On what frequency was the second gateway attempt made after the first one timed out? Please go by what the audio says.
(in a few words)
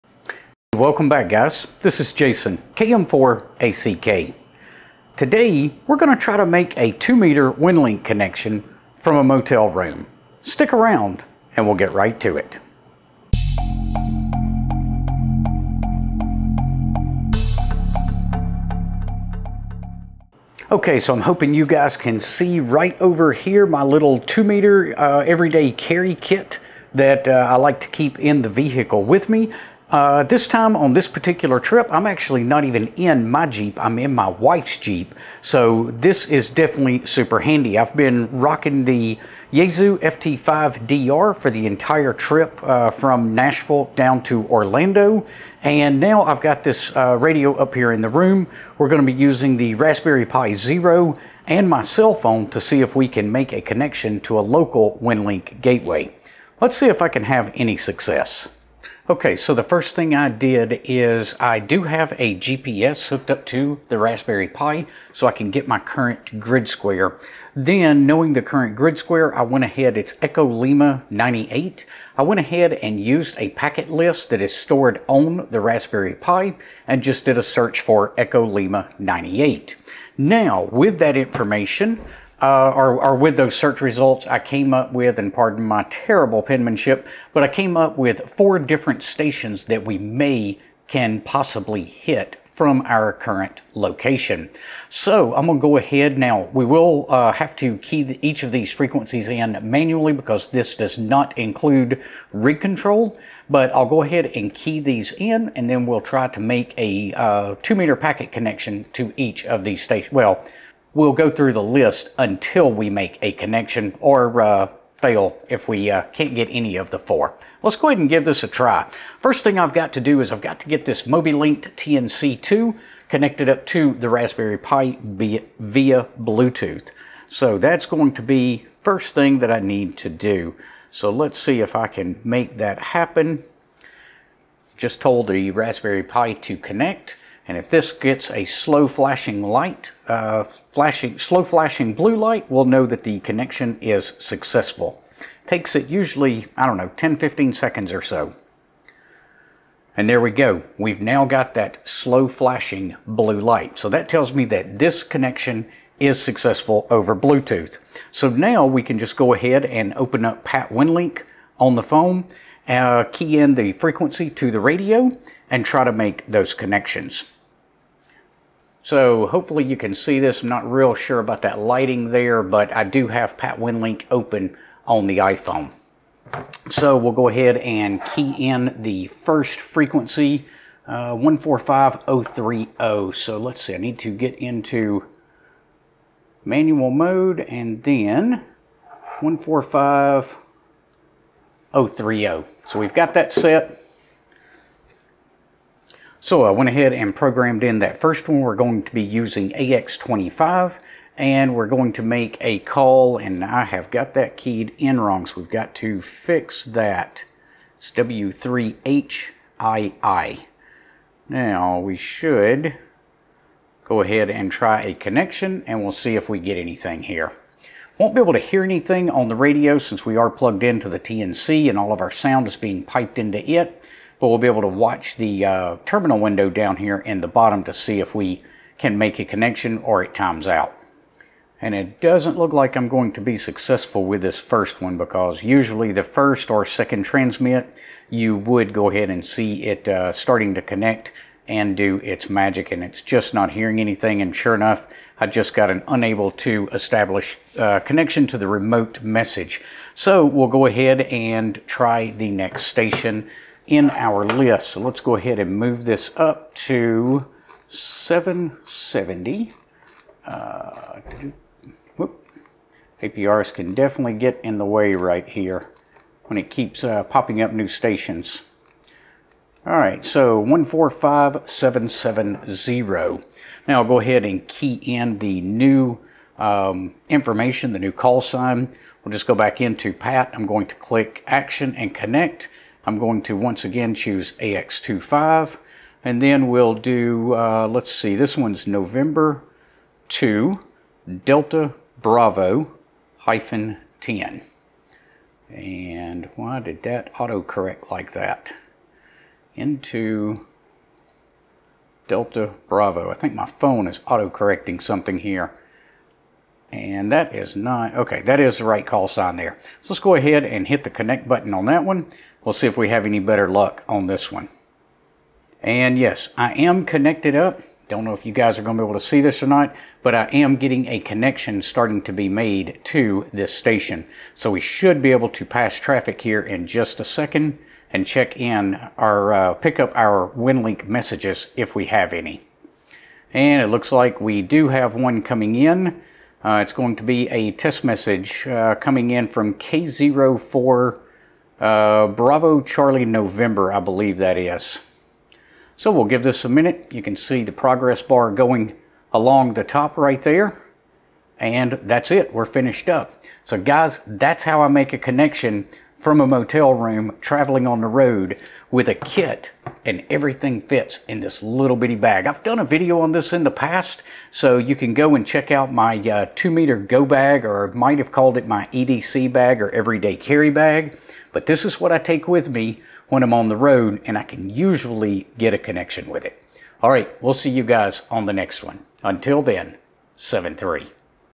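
145.770.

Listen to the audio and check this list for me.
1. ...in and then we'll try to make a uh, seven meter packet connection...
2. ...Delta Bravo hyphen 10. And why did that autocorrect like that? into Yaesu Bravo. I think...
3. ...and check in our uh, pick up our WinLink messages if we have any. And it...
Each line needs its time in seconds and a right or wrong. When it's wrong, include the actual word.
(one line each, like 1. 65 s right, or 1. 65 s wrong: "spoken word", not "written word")
1. 105 s wrong: "two", not "seven"
2. 291 s wrong: "Delta", not "Yaesu"
3. 327 s right.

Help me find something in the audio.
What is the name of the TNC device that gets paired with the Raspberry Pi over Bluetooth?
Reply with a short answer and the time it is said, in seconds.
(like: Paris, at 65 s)
Mobilinkd TNC2, at 121 s.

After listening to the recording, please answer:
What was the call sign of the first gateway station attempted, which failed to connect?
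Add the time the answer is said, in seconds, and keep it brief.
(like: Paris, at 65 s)
W3HII, at 207 s.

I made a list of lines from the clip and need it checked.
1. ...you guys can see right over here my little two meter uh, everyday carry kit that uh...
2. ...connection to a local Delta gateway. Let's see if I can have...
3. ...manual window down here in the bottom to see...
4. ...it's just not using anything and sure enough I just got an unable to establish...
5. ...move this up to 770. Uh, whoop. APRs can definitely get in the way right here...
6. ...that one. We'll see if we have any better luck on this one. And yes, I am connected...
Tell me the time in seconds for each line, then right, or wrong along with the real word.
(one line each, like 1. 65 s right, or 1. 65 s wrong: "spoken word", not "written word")
1. 21 s right
2. 53 s wrong: "WinLink", not "Delta"
3. 225 s wrong: "terminal", not "manual"
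4. 242 s wrong: "hearing", not "using"
5. 255 s right
6. 311 s right.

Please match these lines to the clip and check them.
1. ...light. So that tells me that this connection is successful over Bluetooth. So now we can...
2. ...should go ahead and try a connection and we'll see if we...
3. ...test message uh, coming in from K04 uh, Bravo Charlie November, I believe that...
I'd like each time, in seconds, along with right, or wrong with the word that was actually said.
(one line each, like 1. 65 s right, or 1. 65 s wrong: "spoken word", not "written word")
1. 153 s right
2. 211 s right
3. 337 s right.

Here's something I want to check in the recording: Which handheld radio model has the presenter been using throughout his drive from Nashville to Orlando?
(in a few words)
Yaesu FT5DR.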